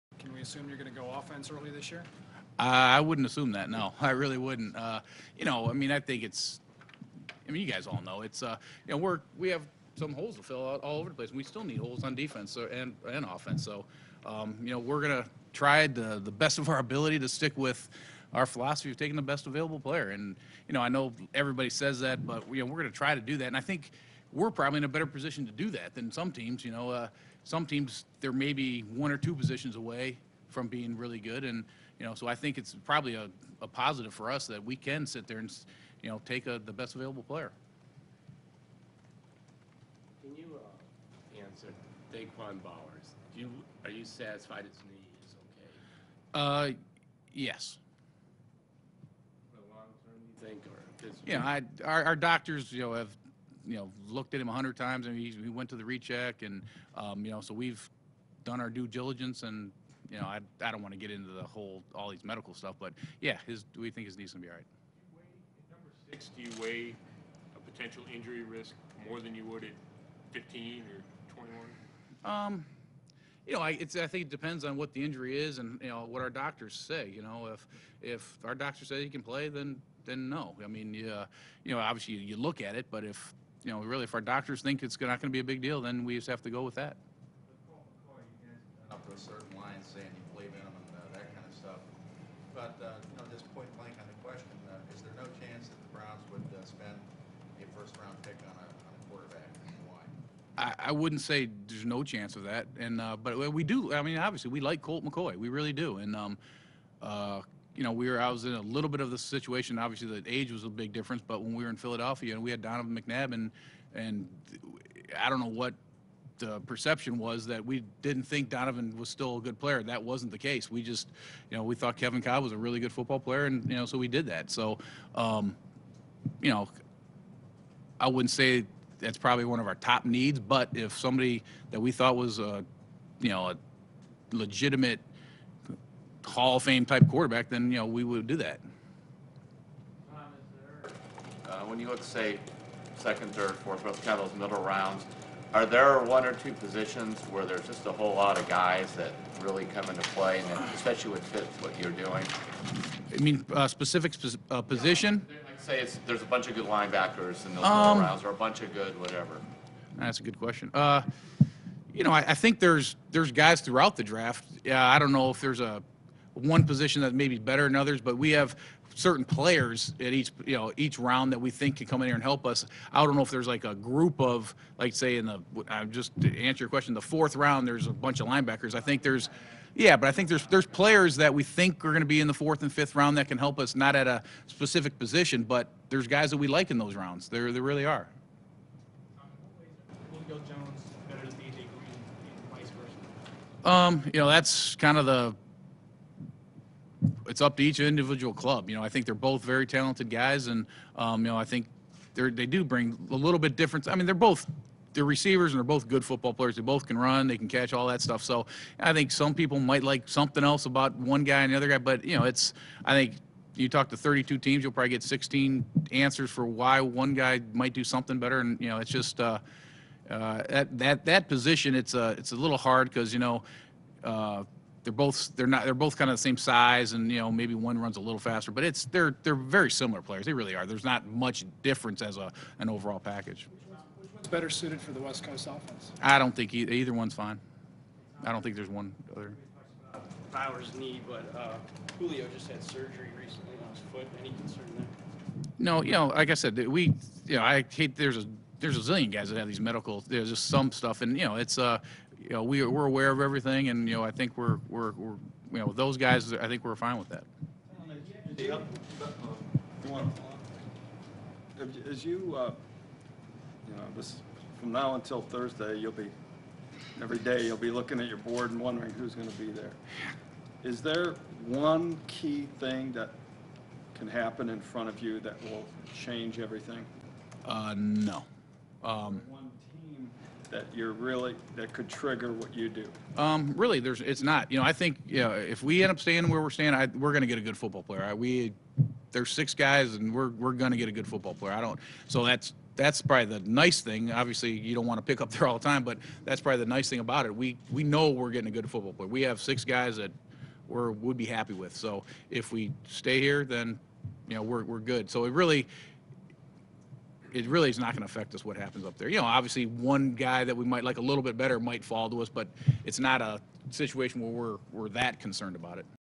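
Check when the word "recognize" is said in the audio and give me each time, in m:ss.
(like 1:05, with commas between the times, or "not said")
not said.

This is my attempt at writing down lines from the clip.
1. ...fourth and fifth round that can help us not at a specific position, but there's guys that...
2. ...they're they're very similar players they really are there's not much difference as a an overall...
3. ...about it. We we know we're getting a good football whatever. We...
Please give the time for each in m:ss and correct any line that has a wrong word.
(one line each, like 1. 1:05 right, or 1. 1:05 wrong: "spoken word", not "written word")
1. 3:02 right
2. 3:48 right
3. 4:57 wrong: "player", not "whatever".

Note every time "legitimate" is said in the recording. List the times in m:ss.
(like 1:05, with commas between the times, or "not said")
2:14.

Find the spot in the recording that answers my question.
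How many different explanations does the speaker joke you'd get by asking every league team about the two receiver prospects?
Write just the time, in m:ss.
3:35.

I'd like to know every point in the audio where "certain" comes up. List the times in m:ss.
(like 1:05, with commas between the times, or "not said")
1:29, 2:48.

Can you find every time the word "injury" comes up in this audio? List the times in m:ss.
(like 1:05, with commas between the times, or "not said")
1:08, 1:15.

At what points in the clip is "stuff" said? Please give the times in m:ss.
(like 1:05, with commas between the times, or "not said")
1:02, 1:31, 3:28, 4:10.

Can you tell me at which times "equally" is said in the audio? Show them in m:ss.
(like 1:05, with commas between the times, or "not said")
not said.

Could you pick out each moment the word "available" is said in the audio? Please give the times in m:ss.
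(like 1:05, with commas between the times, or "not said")
0:19, 0:36.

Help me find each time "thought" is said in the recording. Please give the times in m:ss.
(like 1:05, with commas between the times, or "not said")
2:01, 2:11.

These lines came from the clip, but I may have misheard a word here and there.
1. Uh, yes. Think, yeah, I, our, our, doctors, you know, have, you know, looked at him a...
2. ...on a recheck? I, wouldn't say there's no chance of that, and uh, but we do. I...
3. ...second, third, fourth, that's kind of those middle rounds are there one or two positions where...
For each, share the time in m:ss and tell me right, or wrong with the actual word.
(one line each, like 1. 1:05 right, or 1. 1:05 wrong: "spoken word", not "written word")
1. 0:46 right
2. 1:38 wrong: "quarterback", not "recheck"
3. 2:22 right.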